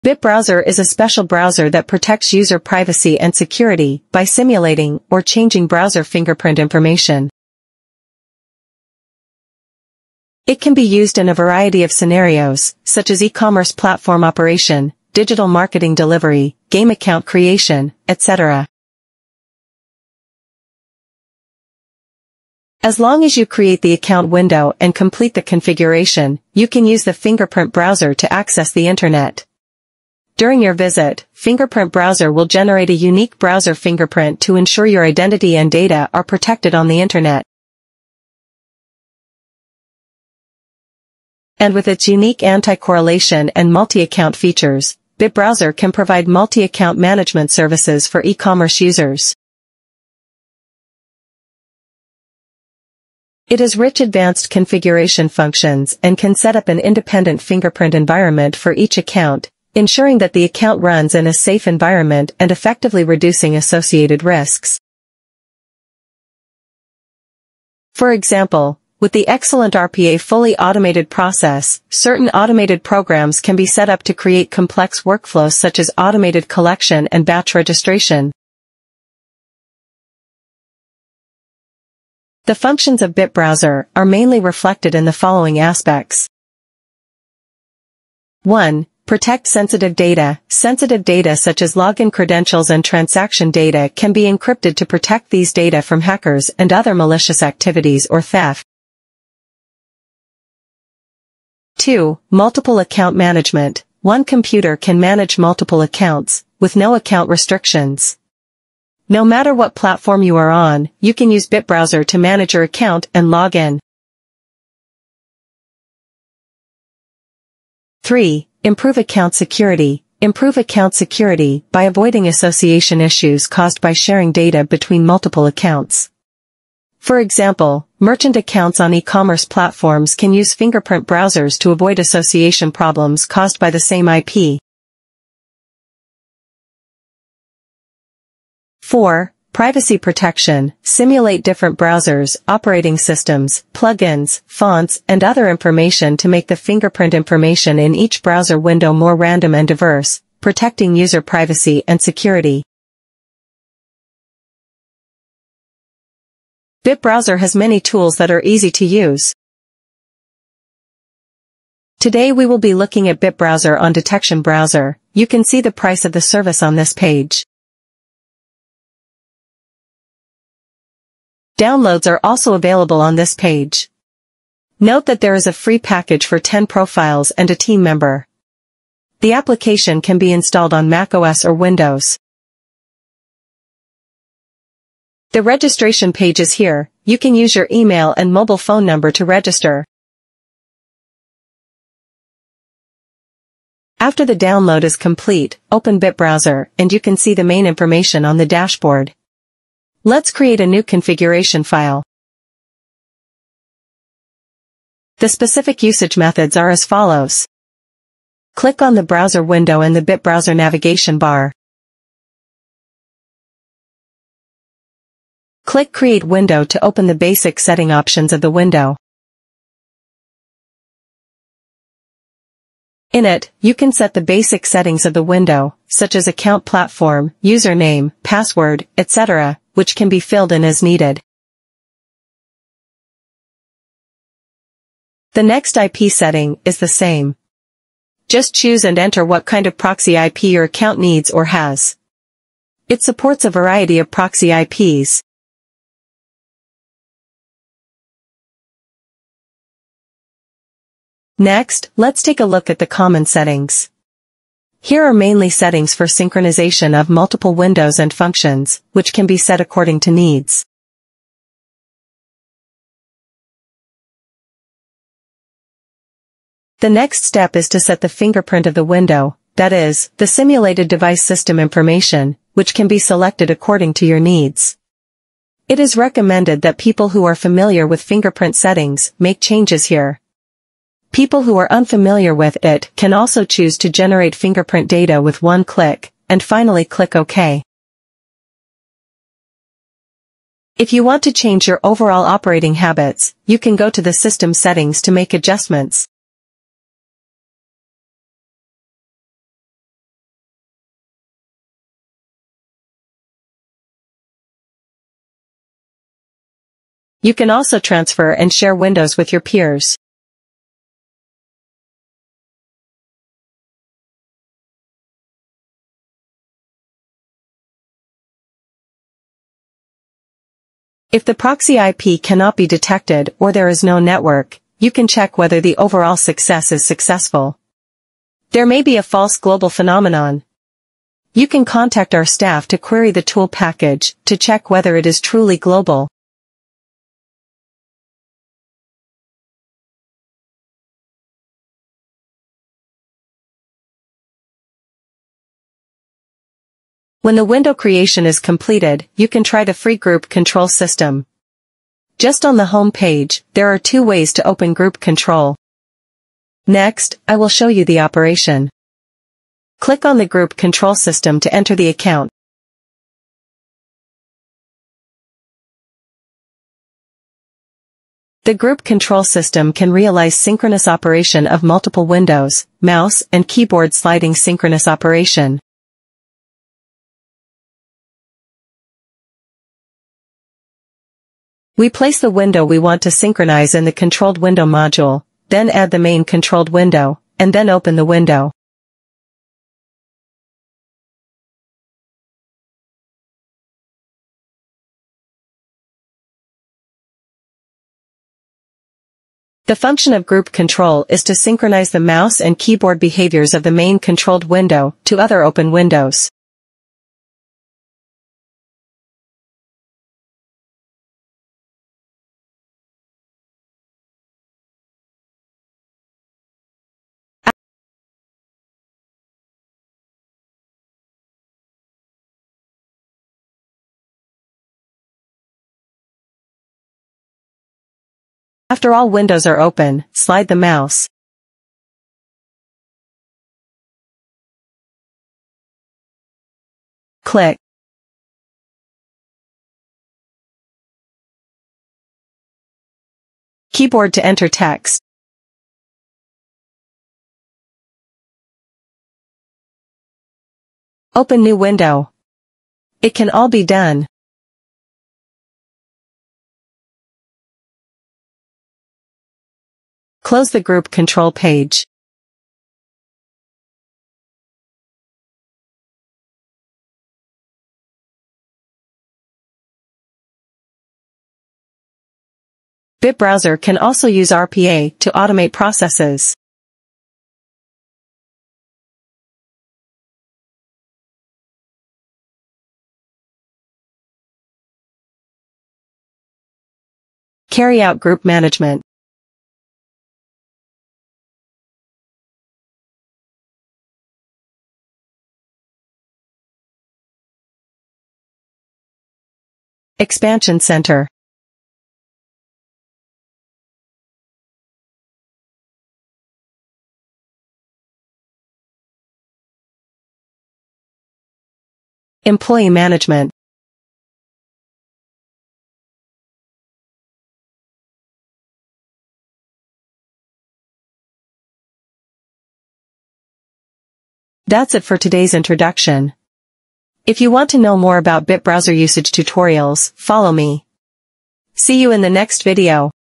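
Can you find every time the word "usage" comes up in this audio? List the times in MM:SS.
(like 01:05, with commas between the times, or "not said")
03:25, 08:48.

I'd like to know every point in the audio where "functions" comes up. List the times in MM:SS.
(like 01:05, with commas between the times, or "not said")
00:55, 01:22, 04:18, 06:39.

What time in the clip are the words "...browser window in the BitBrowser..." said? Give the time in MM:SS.
03:29.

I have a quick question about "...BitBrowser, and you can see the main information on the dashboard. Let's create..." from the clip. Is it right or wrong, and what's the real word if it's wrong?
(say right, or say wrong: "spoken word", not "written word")
right.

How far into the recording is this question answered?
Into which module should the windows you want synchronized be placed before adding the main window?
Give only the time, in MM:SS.
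06:23.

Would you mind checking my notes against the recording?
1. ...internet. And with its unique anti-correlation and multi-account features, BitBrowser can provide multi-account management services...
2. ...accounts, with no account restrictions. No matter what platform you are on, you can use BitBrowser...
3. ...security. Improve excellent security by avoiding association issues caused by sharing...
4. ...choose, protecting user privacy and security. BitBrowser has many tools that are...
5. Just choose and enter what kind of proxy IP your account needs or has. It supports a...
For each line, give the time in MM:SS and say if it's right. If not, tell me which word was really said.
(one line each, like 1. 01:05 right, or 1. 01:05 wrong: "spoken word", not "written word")
1. 00:36 right
2. 01:45 right
3. 01:59 wrong: "account", not "excellent"
4. 02:29 wrong: "diverse", not "choose"
5. 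03:58 right.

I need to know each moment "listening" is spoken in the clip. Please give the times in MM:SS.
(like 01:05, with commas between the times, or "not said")
not said.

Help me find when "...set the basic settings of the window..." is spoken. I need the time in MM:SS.
03:43.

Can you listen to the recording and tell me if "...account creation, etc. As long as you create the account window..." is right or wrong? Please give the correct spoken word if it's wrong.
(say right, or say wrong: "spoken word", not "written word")
right.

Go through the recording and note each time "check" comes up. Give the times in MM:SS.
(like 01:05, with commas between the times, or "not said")
05:25, 05:34.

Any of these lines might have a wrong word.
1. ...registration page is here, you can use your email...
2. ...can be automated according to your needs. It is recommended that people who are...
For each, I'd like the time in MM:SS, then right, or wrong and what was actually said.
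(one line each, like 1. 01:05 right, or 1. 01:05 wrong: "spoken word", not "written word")
1. 03:05 right
2. 04:32 wrong: "selected", not "automated".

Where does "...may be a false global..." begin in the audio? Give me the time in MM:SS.
05:28.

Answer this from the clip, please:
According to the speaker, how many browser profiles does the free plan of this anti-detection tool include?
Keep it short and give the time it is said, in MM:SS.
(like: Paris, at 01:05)
10, at 02:56.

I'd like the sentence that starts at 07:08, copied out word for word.
After all windows are open, slide the mouse.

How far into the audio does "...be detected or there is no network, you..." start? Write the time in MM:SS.
05:22.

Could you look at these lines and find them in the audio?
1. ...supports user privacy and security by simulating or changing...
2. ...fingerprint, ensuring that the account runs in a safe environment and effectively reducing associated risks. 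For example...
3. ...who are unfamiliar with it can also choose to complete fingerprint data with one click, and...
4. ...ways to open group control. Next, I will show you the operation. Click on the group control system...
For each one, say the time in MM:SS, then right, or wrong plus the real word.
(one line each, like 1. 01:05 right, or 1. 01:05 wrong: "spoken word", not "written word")
1. 00:01 wrong: "protects", not "supports"
2. 00:58 wrong: "account", not "fingerprint"
3. 04:41 wrong: "generate", not "complete"
4. 05:54 right.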